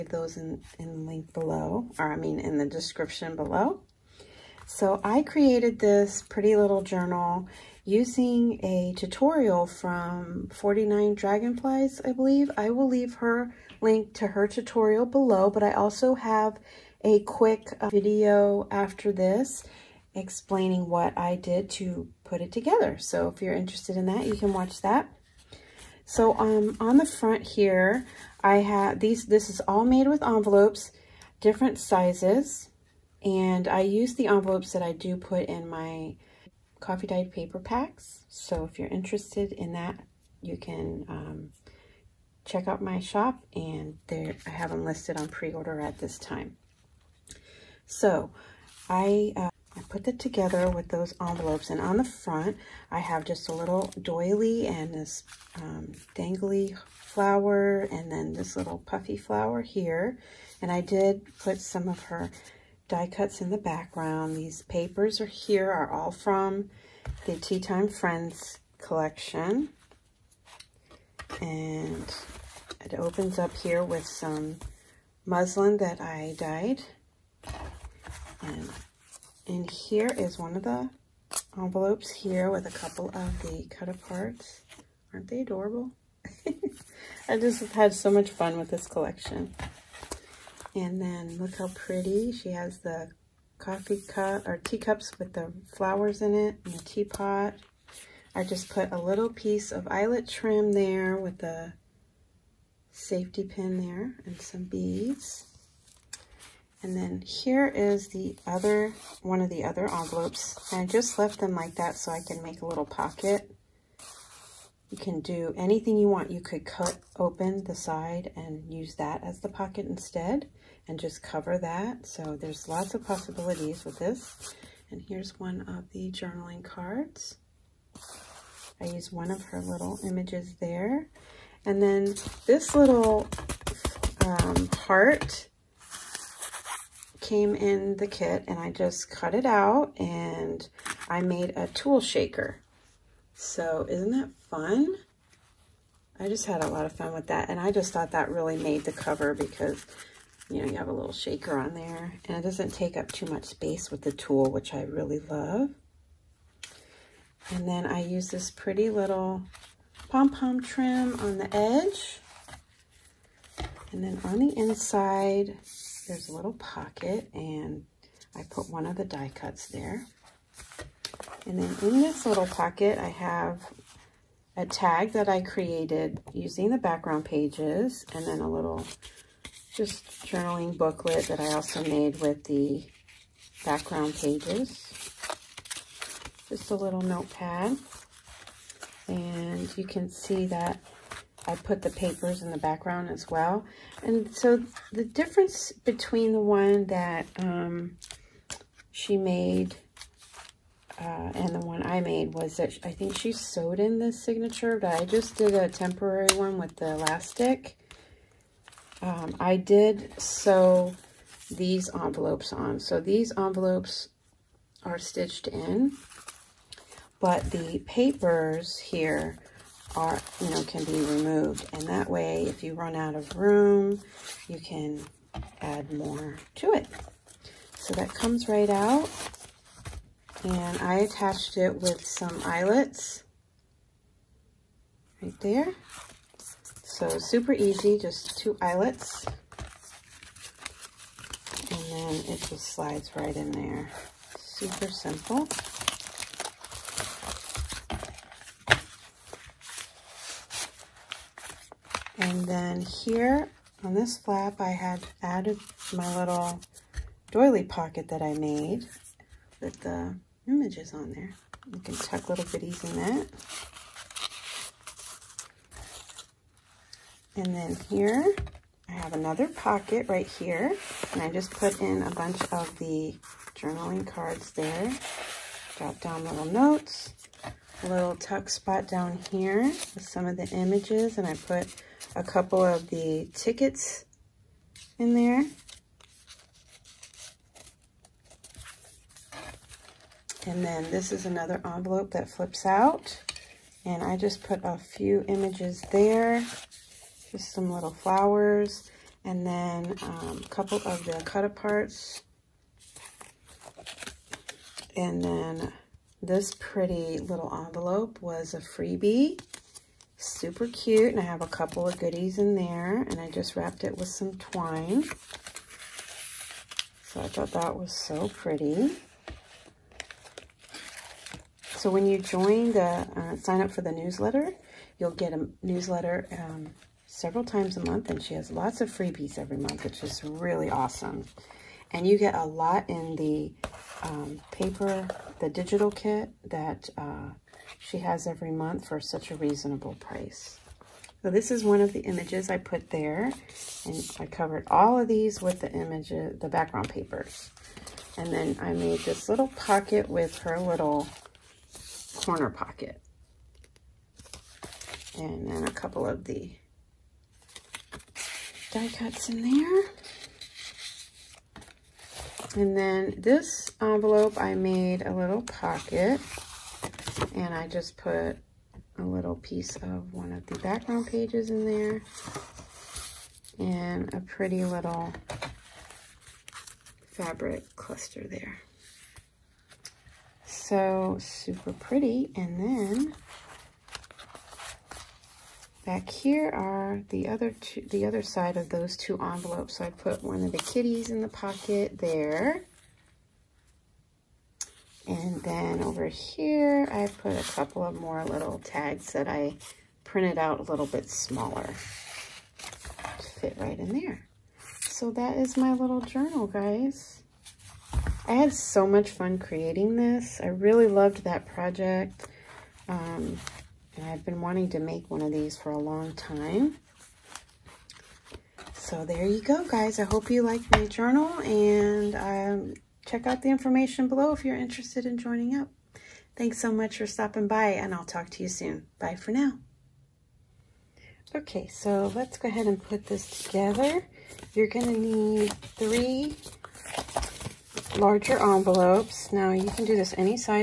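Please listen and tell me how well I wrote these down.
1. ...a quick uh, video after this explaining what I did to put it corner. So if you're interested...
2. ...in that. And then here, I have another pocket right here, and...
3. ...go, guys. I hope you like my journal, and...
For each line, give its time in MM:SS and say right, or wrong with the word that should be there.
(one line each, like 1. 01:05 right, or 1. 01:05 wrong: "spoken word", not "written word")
1. 00:17 wrong: "together", not "corner"
2. 04:22 right
3. 06:59 right.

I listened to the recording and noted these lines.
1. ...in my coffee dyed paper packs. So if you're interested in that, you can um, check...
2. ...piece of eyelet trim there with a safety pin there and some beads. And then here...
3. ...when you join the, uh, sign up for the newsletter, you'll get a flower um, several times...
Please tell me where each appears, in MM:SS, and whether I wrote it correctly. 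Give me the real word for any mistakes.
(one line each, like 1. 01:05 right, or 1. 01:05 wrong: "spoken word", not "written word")
1. 00:35 right
2. 01:39 right
3. 05:21 wrong: "newsletter", not "flower".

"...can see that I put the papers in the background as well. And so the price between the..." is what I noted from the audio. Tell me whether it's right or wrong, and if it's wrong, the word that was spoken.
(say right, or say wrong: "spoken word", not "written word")
wrong: "difference", not "price".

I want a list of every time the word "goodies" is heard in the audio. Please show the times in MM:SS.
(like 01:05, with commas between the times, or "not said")
04:22, 05:11.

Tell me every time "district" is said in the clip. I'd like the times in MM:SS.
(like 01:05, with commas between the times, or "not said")
not said.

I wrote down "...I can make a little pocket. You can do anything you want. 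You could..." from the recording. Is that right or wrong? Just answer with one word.
right.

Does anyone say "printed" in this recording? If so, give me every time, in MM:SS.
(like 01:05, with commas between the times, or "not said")
06:40.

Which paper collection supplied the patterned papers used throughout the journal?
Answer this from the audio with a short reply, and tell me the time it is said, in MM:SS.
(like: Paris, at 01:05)
Tea Time Friends, at 01:07.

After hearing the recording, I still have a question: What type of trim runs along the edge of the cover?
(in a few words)
pom-pom trim.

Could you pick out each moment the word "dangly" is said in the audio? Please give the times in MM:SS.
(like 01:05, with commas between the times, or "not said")
00:56.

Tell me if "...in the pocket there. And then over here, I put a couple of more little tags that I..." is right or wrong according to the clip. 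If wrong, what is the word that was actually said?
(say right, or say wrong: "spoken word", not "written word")
right.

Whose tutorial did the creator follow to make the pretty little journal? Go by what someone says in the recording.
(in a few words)
49 Dragonflies.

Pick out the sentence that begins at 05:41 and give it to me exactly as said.
So this is one of the images I put there.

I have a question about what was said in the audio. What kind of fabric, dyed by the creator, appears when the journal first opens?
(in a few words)
muslin.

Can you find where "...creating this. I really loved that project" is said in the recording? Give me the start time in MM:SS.
06:49.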